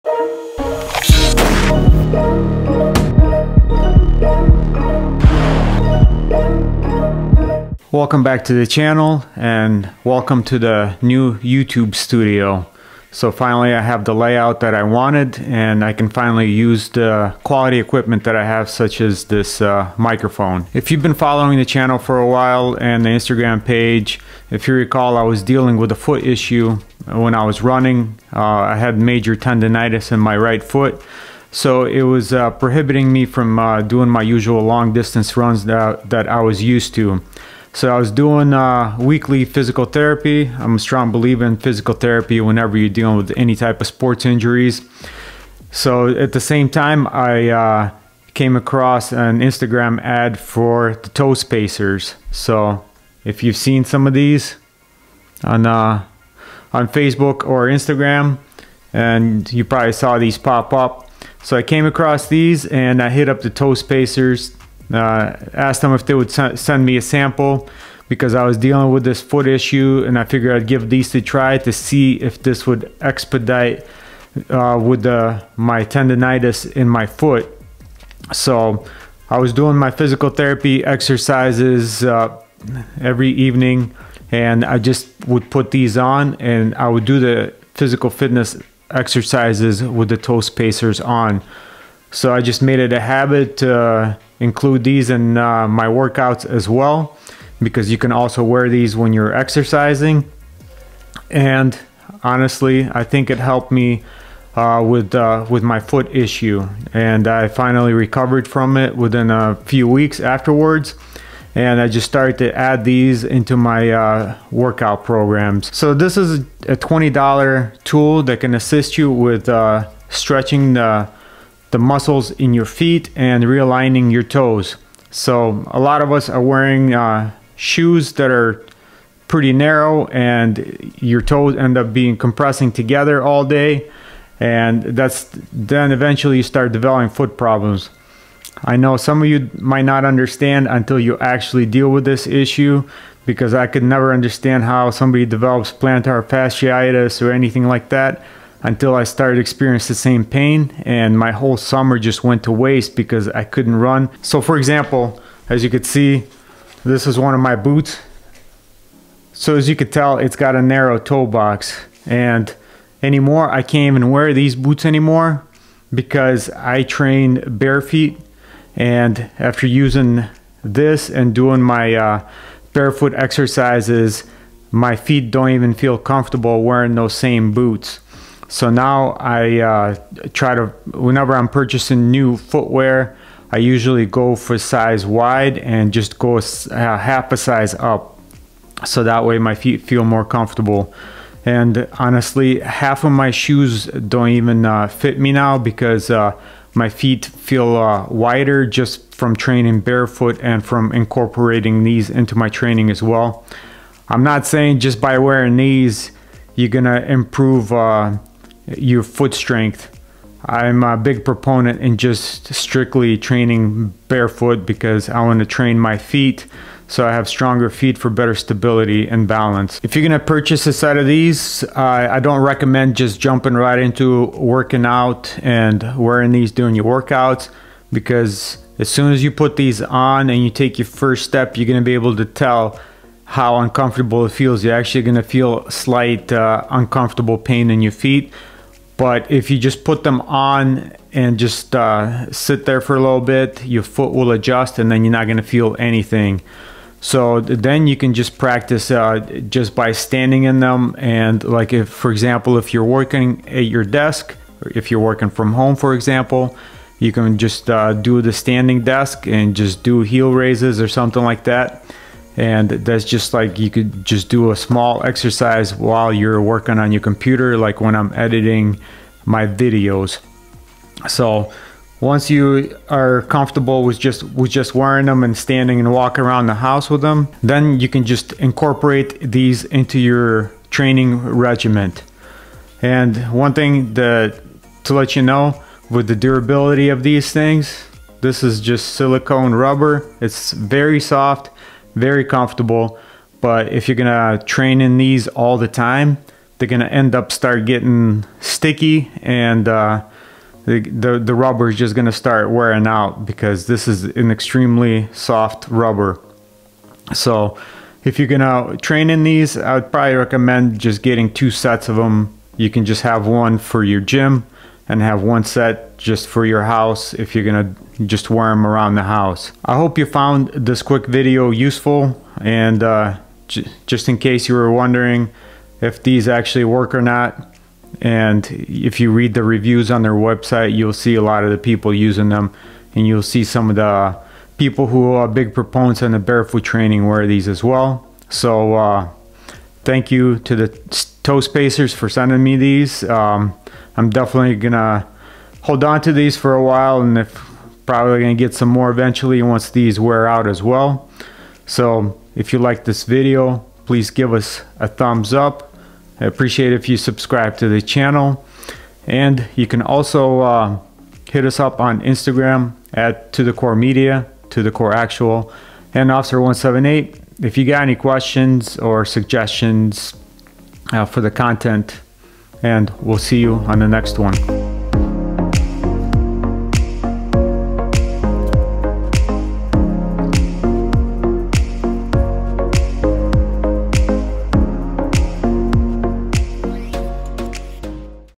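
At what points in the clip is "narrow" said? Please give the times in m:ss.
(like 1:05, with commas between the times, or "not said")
2:09, 2:40.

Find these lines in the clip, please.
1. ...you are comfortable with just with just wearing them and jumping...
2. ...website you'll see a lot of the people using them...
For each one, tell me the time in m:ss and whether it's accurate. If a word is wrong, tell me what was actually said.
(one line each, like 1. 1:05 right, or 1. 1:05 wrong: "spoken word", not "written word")
1. 4:32 wrong: "standing", not "jumping"
2. 5:30 right.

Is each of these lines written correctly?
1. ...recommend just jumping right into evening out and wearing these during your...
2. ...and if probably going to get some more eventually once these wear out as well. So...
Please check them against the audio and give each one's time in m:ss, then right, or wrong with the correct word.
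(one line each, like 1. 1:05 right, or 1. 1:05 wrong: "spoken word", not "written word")
1. 3:42 wrong: "working", not "evening"
2. 5:47 right.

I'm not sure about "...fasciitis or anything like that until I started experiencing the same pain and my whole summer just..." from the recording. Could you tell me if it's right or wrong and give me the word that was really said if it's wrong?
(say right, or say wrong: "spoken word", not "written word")
right.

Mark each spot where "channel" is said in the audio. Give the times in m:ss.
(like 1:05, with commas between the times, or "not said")
0:08, 0:21, 5:57.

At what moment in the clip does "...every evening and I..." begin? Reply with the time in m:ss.
1:22.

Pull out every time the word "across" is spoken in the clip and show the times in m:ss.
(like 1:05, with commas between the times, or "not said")
0:48, 1:01.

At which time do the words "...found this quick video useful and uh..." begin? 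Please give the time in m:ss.
5:20.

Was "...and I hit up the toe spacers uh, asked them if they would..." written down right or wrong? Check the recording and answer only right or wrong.
right.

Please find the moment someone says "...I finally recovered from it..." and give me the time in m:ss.
1:47.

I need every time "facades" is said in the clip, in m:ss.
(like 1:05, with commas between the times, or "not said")
not said.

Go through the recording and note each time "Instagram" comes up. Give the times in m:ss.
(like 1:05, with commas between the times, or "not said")
0:23, 0:49, 0:57, 6:02.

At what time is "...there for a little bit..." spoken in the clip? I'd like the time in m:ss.
4:02.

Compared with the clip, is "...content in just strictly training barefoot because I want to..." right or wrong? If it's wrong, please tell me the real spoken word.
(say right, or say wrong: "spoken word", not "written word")
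wrong: "proponent", not "content".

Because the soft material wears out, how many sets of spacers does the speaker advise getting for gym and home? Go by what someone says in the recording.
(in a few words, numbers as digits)
2 sets.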